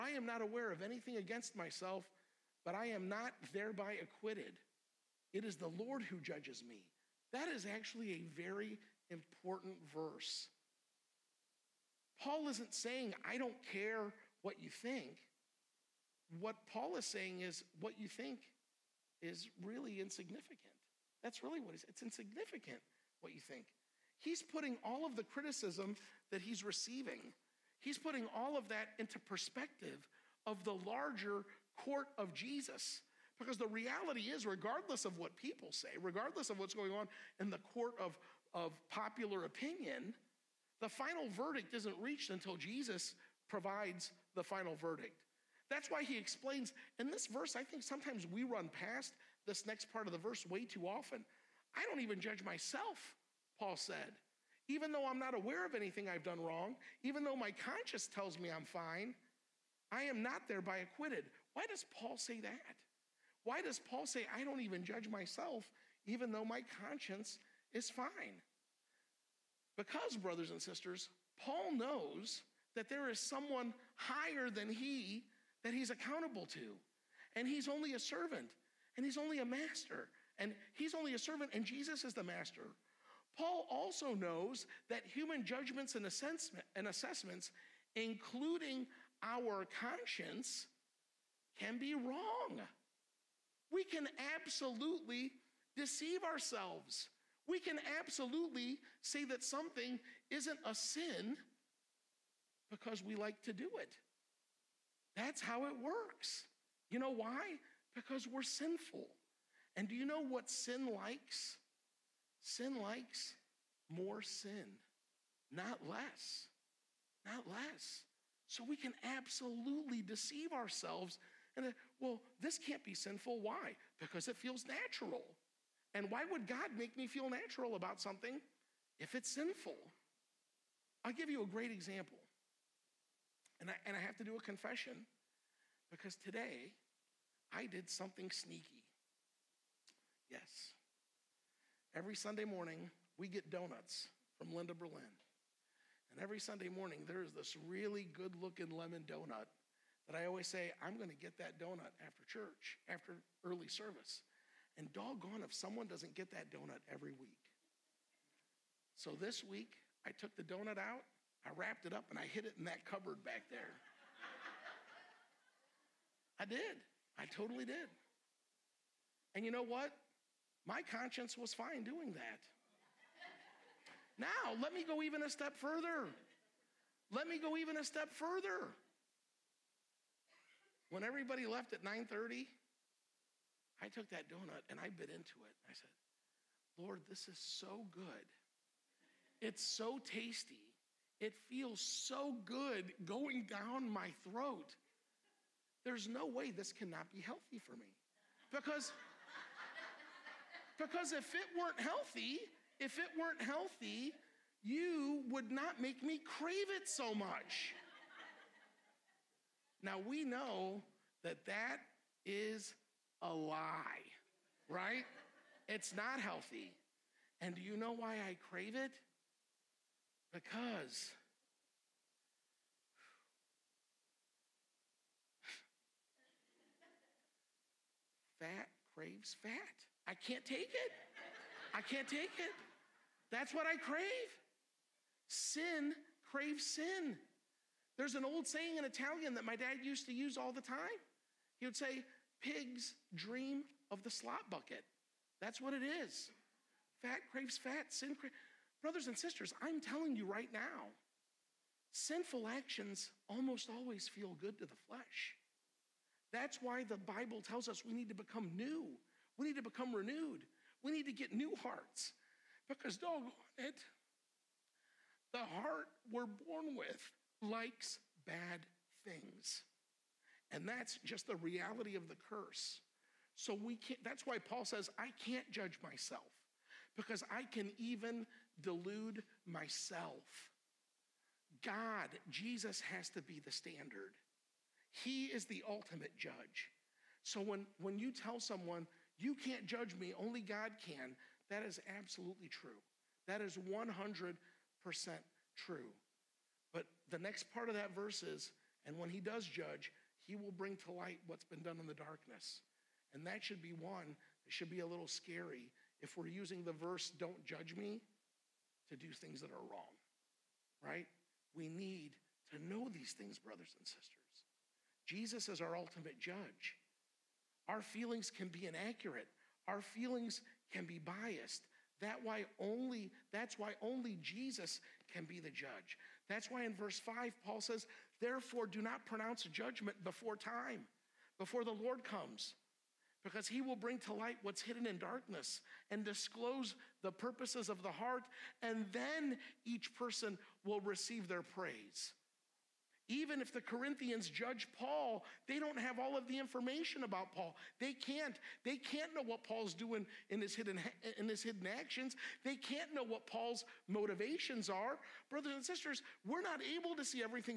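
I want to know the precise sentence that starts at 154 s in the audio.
And doggone if someone doesn't get that donut every week.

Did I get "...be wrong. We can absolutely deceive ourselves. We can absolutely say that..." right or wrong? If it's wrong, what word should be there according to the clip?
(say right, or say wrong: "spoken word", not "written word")
right.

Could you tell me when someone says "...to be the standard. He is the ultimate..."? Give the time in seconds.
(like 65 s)
283 s.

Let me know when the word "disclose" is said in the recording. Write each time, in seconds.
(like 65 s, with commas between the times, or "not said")
336 s.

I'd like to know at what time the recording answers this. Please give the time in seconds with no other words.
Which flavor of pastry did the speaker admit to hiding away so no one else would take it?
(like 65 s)
148 s.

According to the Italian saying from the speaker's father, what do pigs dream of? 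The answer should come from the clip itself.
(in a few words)
The slop bucket.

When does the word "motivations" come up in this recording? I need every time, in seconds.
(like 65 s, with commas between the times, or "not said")
353 s.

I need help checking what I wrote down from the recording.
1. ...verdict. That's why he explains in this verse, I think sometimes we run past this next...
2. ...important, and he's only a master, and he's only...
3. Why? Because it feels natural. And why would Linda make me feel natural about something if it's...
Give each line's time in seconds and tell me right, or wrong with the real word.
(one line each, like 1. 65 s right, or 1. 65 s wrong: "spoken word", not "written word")
1. 44 s right
2. 77 s wrong: "servant", not "important"
3. 123 s wrong: "God", not "Linda".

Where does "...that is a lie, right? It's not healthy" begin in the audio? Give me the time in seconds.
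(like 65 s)
211 s.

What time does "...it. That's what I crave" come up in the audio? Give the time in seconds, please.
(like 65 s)
232 s.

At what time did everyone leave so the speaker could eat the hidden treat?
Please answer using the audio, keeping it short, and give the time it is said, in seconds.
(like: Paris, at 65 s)
9:30, at 181 s.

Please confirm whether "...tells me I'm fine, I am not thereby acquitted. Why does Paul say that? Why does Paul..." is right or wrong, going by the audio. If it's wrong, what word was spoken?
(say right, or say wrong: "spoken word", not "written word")
right.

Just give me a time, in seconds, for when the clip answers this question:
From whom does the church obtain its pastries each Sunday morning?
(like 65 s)
144 s.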